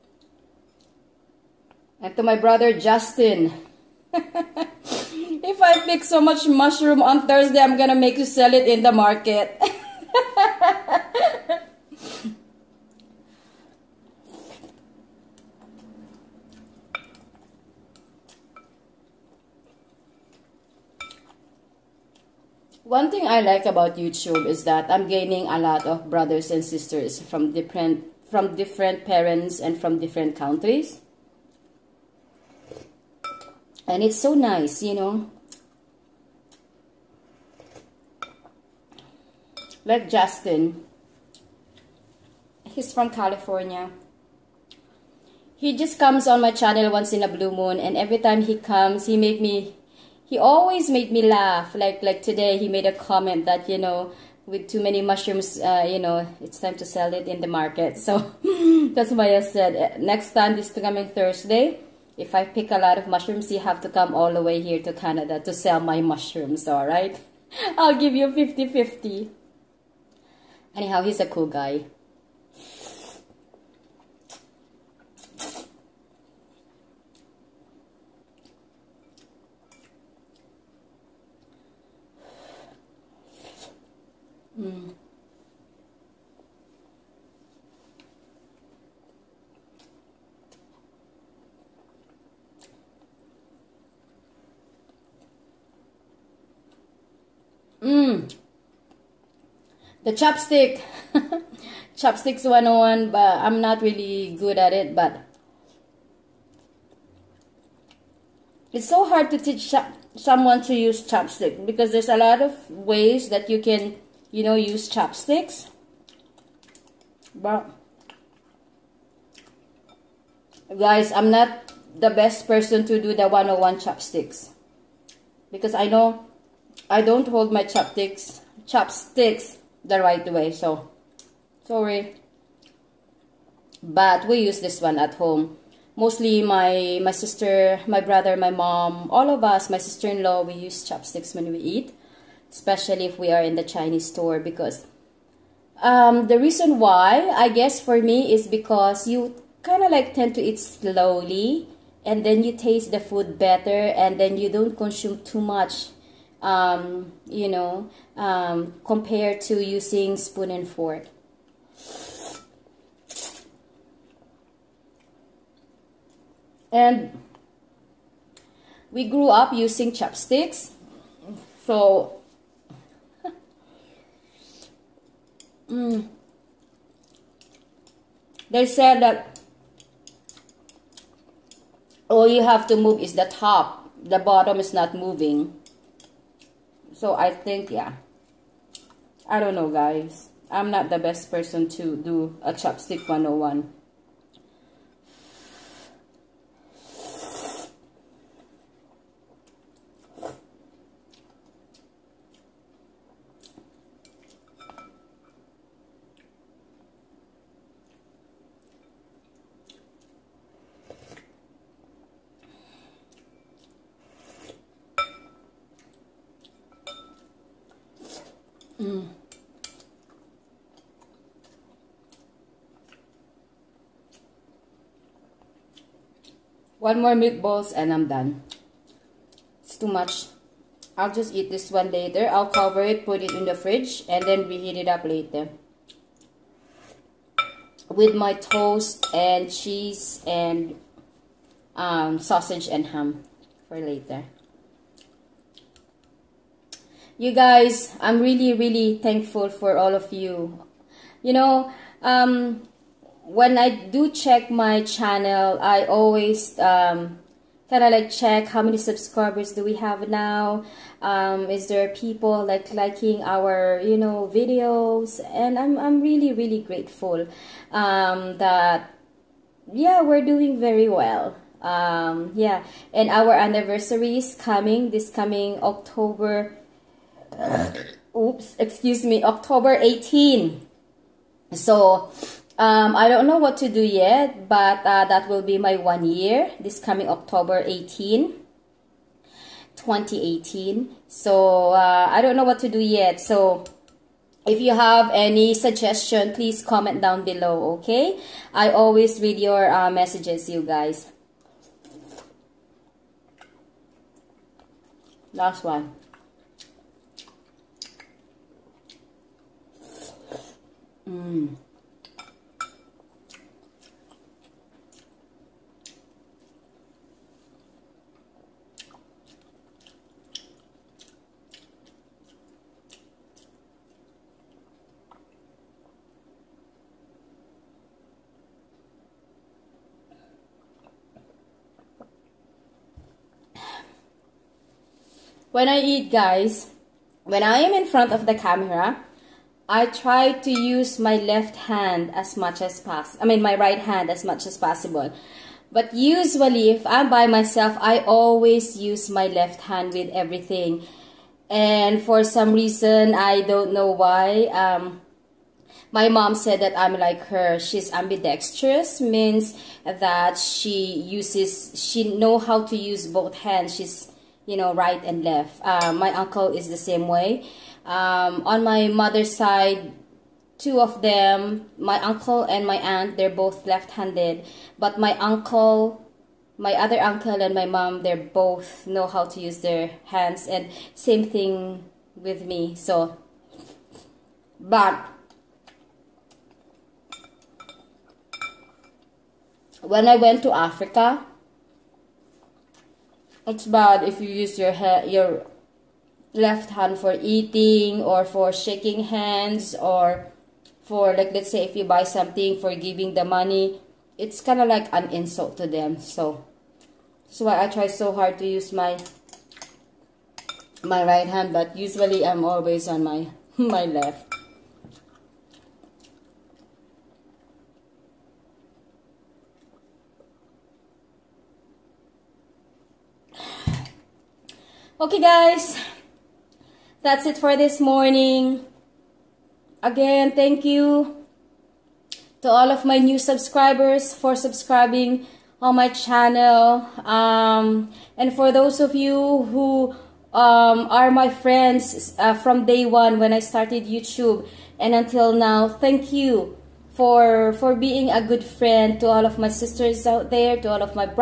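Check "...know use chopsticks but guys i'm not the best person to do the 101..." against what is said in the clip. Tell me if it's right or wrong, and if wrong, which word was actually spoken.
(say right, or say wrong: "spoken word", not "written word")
right.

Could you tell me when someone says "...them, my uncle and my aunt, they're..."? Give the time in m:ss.
6:11.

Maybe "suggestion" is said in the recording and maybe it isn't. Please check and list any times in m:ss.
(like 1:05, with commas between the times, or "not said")
4:55.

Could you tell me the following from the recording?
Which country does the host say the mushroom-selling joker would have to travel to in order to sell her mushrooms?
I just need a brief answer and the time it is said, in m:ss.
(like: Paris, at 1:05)
Canada, at 1:04.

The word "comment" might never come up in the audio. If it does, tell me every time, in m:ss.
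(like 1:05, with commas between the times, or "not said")
0:52, 4:56.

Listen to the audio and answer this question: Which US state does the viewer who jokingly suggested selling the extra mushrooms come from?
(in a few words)
California.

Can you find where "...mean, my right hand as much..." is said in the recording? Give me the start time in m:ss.
5:43.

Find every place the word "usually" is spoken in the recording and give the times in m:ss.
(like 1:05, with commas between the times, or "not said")
5:45, 6:51.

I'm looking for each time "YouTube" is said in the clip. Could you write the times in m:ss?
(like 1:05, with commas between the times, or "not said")
0:23, 7:23.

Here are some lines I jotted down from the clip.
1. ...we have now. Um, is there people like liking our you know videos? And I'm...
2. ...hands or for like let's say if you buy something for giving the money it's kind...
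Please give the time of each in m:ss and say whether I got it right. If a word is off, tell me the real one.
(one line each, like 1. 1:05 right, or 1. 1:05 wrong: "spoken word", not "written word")
1. 4:19 right
2. 6:39 right.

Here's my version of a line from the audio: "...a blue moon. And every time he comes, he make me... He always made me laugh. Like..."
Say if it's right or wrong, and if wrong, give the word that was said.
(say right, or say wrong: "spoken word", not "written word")
right.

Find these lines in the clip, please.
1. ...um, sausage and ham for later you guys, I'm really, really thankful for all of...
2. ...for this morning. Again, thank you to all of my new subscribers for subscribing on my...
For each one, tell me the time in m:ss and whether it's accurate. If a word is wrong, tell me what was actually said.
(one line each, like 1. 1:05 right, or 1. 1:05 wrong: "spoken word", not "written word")
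1. 4:01 right
2. 7:07 right.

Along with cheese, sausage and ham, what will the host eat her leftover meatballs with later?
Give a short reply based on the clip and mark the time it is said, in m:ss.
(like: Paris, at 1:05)
toast, at 3:58.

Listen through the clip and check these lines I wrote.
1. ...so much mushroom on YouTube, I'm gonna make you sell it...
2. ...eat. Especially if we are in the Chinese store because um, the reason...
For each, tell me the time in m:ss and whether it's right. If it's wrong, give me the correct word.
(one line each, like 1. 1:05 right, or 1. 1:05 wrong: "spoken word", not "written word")
1. 0:06 wrong: "Thursday", not "YouTube"
2. 2:21 right.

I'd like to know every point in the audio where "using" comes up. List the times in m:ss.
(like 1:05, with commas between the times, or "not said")
2:39, 2:49.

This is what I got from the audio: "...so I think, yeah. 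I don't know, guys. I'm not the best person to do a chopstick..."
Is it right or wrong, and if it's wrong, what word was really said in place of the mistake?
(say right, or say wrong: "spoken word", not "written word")
right.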